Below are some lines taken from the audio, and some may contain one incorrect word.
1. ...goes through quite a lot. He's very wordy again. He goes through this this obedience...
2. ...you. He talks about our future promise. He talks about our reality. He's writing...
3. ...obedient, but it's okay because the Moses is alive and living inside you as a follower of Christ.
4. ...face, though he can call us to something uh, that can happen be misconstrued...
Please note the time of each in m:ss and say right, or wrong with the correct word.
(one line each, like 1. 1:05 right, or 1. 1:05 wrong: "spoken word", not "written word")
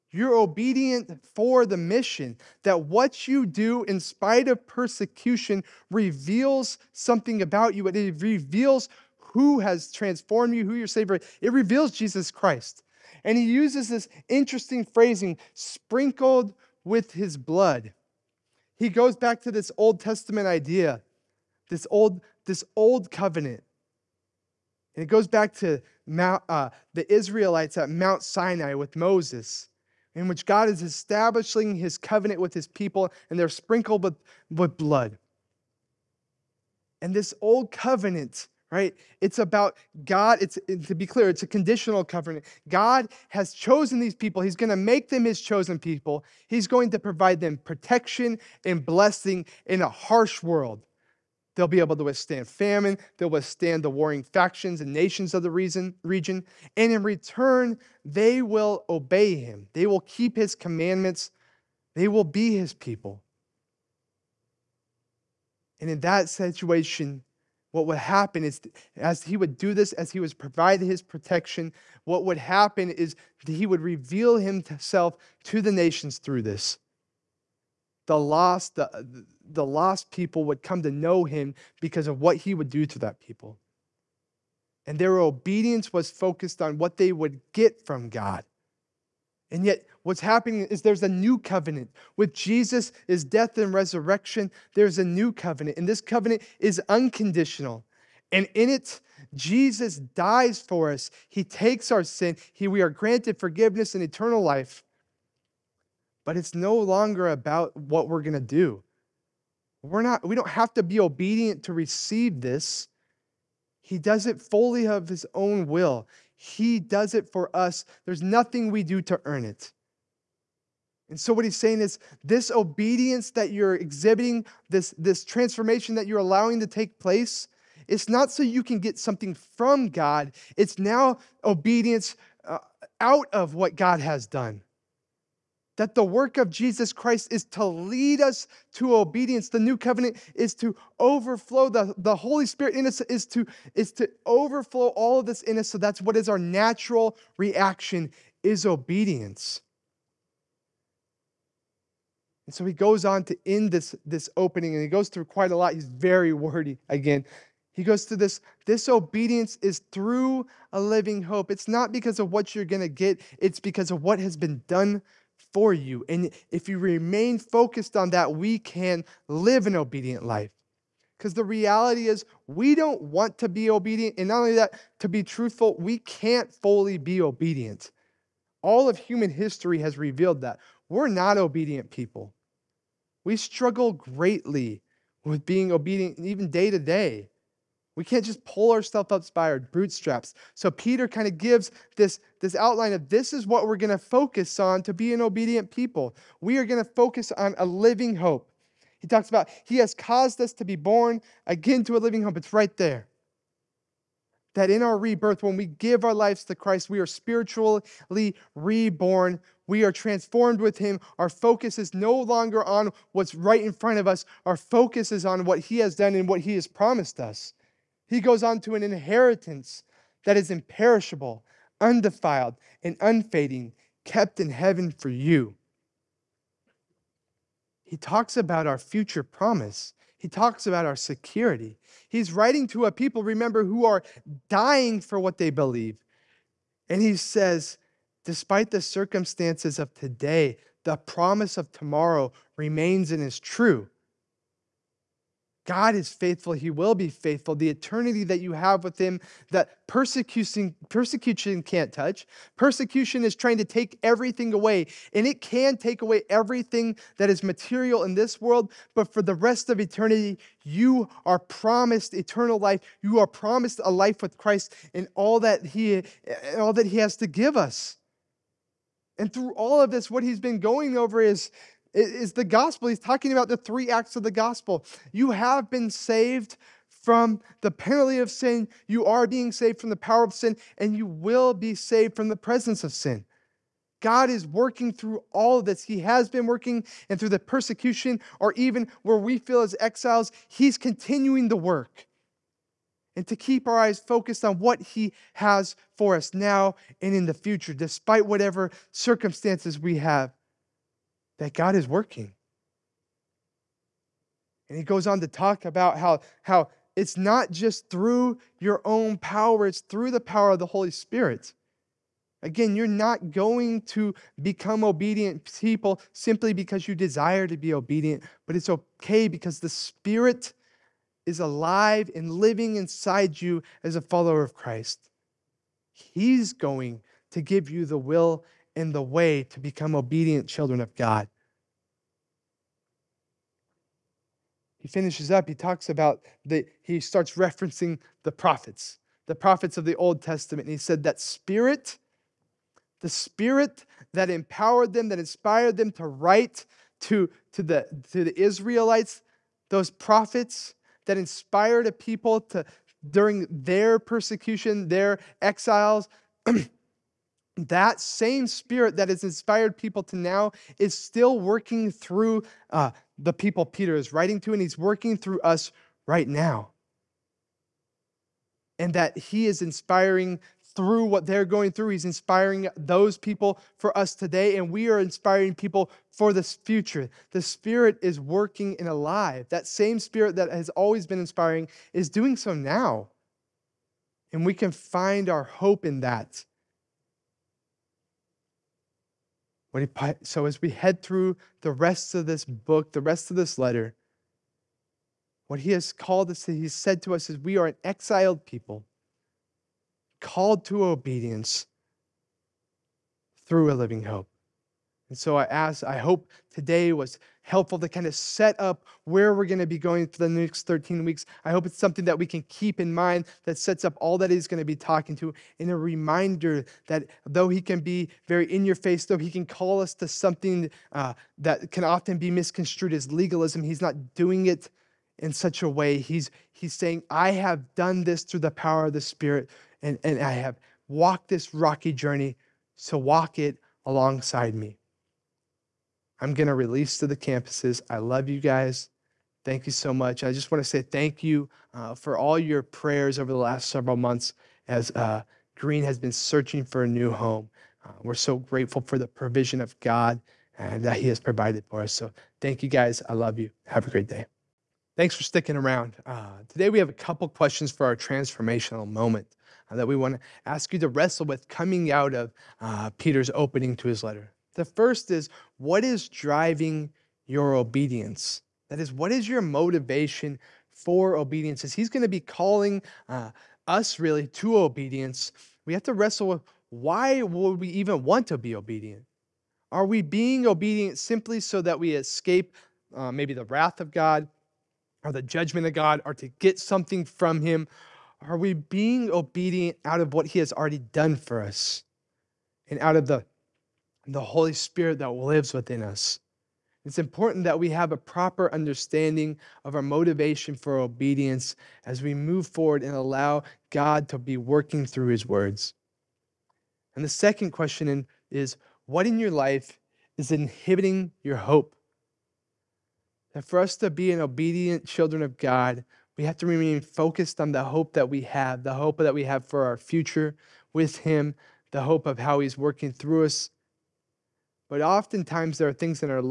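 1. 2:34 right
2. 3:45 wrong: "security", not "reality"
3. 5:17 wrong: "Spirit", not "Moses"
4. 6:58 wrong: "often", not "happen".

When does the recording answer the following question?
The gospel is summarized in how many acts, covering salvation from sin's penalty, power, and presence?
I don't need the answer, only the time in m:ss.
4:33.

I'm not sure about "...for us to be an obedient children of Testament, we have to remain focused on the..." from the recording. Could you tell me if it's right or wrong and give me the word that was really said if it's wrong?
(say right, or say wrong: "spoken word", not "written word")
wrong: "God", not "Testament".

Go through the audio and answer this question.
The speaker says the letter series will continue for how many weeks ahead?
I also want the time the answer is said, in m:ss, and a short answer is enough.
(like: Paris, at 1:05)
13, at 6:50.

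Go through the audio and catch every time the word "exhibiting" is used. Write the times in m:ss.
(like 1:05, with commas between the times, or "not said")
2:03.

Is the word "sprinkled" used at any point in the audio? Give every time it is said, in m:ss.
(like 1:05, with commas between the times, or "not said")
0:15, 0:33.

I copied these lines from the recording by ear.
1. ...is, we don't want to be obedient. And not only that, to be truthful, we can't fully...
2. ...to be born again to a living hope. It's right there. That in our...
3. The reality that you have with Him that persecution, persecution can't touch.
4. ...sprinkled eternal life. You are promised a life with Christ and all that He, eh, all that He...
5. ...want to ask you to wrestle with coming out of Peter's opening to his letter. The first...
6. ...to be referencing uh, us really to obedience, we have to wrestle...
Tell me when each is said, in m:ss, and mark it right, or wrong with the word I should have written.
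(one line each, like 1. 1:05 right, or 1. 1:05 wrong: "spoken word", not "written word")
1. 2:52 right
2. 3:20 right
3. 4:07 wrong: "eternity", not "reality"
4. 4:21 wrong: "promised", not "sprinkled"
5. 7:39 right
6. 7:52 wrong: "calling", not "referencing".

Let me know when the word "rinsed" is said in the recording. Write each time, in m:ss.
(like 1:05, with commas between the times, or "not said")
not said.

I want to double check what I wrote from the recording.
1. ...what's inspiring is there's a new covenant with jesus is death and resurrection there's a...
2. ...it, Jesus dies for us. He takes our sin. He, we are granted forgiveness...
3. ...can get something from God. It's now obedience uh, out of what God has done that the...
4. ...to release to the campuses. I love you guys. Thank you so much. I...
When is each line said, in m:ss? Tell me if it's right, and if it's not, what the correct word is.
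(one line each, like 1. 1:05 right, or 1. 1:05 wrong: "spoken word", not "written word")
1. 1:30 wrong: "happening", not "inspiring"
2. 1:38 right
3. 2:08 right
4. 7:16 right.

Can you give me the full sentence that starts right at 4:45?
He has been working, and through the persecution, or even where we feel as exiles, He's continuing the work.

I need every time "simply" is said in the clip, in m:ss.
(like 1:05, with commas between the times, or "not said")
5:16, 8:00.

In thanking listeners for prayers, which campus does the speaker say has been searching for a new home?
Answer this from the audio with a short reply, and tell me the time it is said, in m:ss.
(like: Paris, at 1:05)
Green, at 7:25.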